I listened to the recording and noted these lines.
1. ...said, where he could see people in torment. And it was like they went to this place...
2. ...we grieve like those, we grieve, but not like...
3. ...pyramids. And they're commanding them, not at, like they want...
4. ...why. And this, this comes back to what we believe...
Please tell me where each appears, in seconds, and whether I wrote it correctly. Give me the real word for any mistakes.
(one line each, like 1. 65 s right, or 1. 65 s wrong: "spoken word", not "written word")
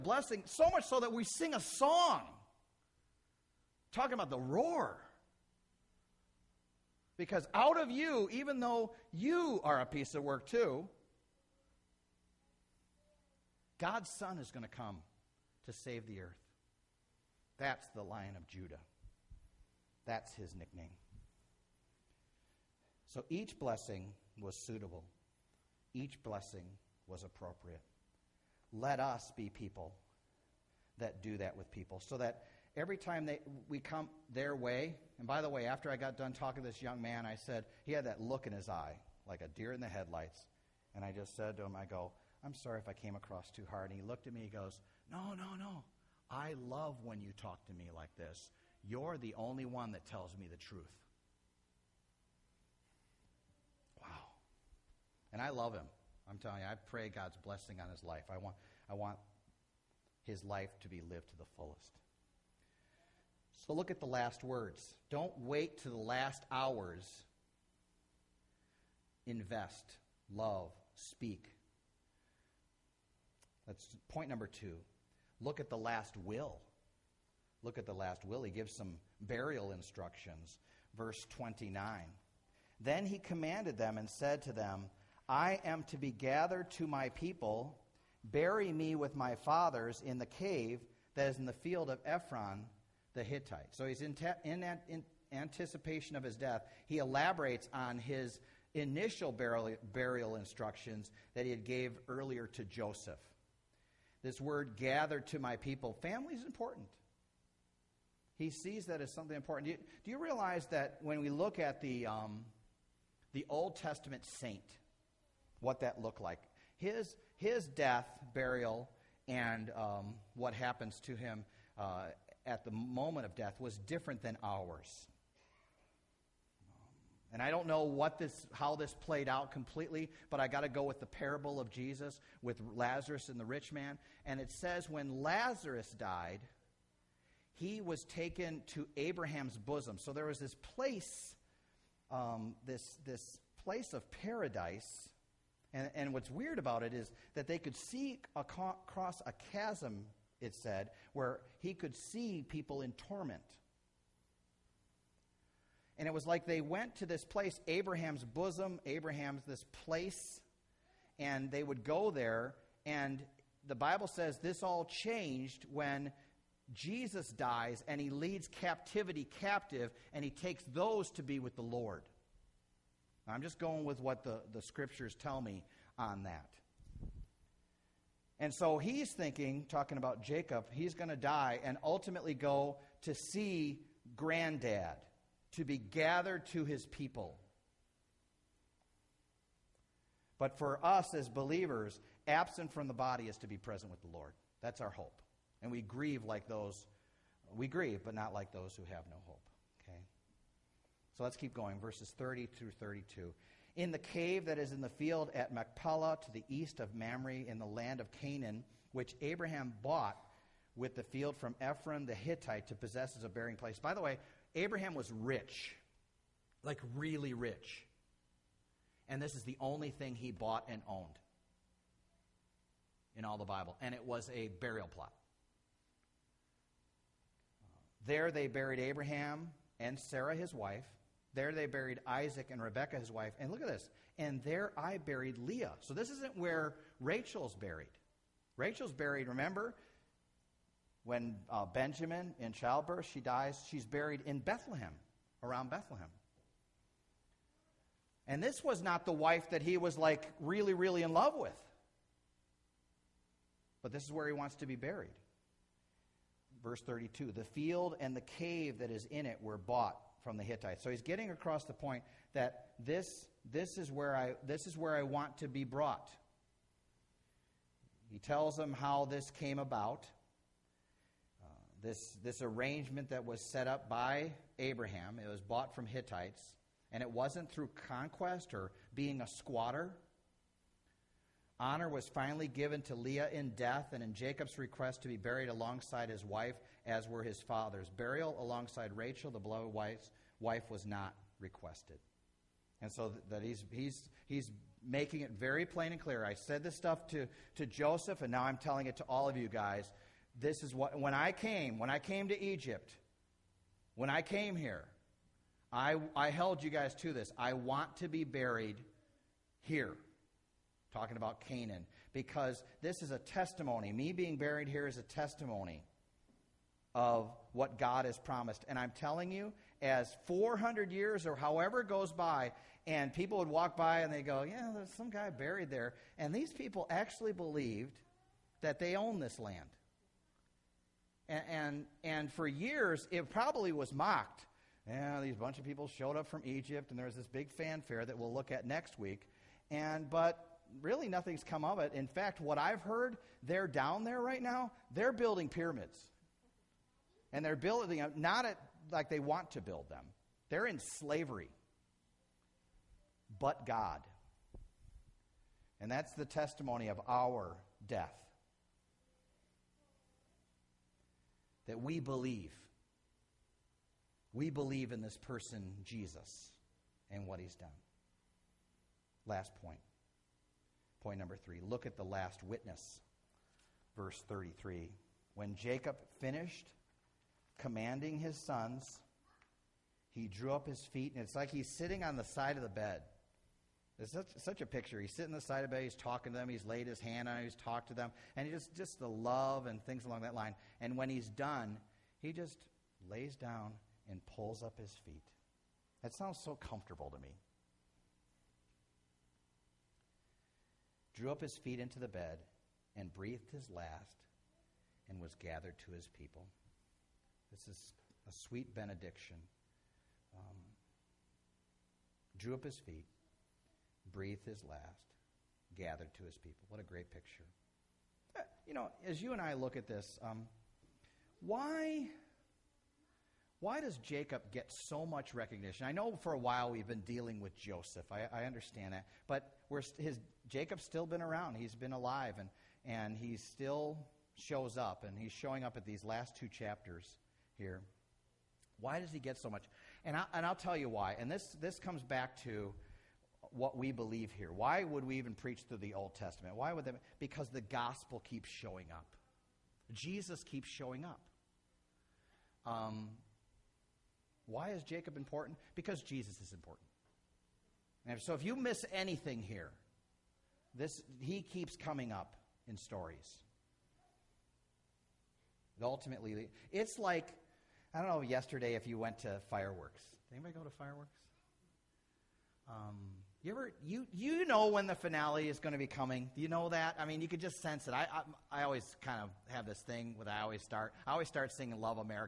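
1. 150 s right
2. 195 s right
3. 345 s wrong: "building", not "commanding"
4. 440 s right.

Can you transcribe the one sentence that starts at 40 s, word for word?
And I just said to him, I go, I'm sorry if I came across too hard.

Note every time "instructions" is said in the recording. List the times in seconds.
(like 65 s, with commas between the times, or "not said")
79 s, 100 s.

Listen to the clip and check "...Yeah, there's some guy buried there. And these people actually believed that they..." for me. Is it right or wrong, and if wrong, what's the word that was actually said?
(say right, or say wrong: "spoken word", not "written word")
right.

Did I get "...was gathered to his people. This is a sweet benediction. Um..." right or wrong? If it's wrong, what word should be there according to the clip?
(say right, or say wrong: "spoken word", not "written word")
right.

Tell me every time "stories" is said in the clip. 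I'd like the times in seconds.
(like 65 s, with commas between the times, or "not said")
462 s.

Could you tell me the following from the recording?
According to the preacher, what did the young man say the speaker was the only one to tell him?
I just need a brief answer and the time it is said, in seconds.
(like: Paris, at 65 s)
The truth, at 50 s.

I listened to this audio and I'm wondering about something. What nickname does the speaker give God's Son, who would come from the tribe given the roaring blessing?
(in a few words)
Lion of Judah.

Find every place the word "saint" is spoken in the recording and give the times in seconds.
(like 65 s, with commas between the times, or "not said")
114 s.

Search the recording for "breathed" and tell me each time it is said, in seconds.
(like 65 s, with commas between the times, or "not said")
403 s, 414 s.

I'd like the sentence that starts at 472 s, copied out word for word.
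Um, you ever you you know when the finale is going to be coming?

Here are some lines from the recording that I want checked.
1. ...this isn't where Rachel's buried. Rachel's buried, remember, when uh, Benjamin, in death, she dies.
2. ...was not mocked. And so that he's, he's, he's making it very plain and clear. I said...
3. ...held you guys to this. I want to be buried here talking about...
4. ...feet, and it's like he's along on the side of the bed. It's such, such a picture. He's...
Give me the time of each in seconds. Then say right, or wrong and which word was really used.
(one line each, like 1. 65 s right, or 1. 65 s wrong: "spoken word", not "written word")
1. 235 s wrong: "childbirth", not "death"
2. 290 s wrong: "requested", not "mocked"
3. 306 s right
4. 380 s wrong: "sitting", not "along".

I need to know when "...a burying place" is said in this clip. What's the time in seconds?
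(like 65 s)
213 s.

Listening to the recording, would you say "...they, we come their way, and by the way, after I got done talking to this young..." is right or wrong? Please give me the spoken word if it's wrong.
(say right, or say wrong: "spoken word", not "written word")
right.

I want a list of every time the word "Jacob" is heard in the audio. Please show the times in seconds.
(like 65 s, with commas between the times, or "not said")
180 s, 284 s, 375 s, 423 s, 430 s, 454 s.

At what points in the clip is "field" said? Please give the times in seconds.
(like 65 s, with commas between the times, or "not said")
91 s, 204 s, 211 s, 257 s.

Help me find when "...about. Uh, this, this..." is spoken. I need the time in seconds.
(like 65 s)
269 s.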